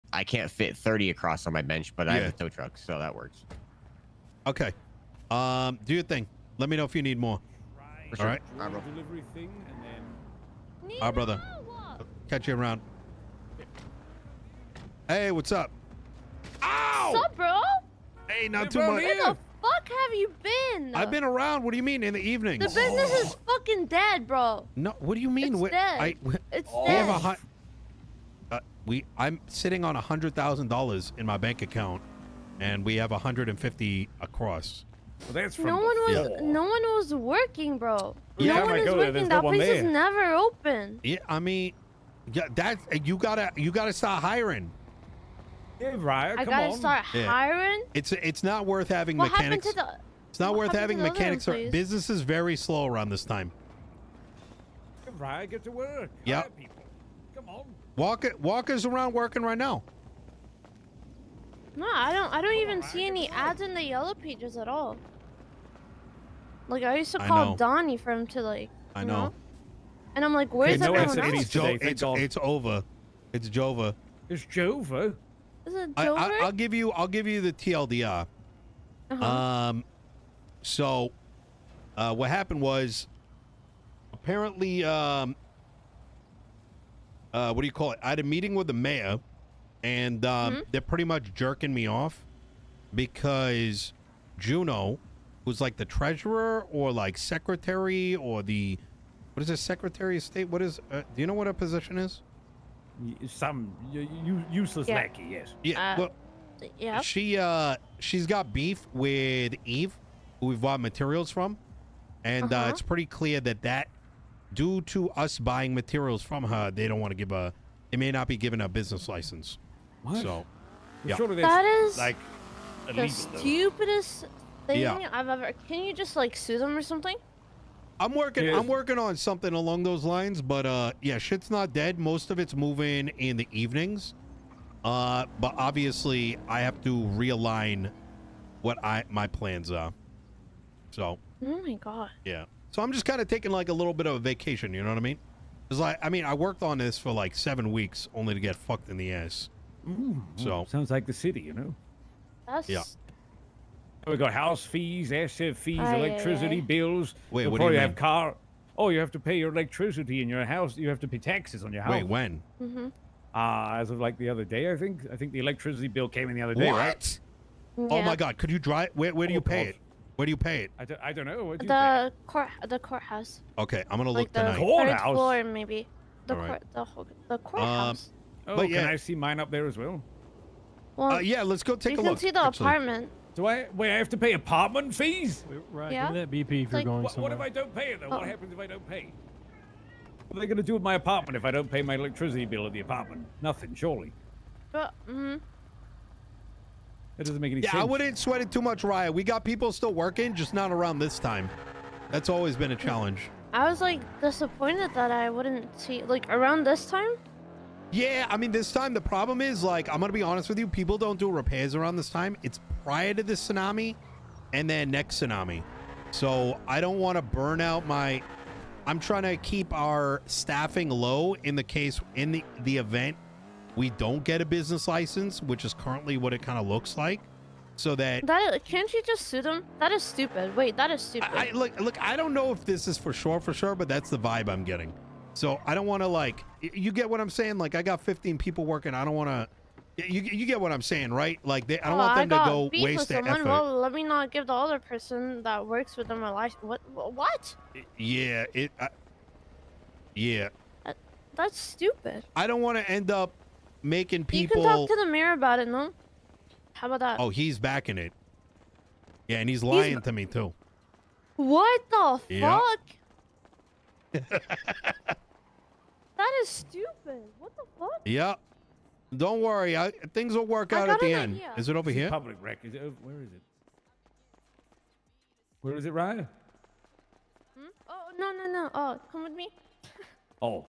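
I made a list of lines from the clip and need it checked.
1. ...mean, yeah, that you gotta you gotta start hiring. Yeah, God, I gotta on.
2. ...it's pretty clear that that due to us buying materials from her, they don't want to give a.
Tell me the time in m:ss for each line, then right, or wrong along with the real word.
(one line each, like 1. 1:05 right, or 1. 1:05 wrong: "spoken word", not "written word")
1. 0:41 wrong: "Raya", not "God"
2. 1:52 right.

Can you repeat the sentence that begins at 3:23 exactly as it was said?
I was like disappointed that I wouldn't see like around this time.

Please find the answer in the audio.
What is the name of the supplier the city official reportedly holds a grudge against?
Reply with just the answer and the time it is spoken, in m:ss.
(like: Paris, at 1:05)
Eve, at 1:49.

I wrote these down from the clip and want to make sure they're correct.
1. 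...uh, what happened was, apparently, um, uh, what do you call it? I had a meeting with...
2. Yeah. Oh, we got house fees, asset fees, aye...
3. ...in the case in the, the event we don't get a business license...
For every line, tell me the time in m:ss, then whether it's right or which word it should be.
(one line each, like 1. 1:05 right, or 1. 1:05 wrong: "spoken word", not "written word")
1. 1:21 right
2. 2:32 right
3. 3:41 right.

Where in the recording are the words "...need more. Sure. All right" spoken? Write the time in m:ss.
0:07.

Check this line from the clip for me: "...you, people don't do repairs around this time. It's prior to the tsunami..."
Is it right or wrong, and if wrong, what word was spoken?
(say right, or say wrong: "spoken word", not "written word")
right.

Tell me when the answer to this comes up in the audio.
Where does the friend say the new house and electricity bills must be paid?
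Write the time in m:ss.
2:52.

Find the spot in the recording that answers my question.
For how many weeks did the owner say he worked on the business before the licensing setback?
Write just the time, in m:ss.
2:27.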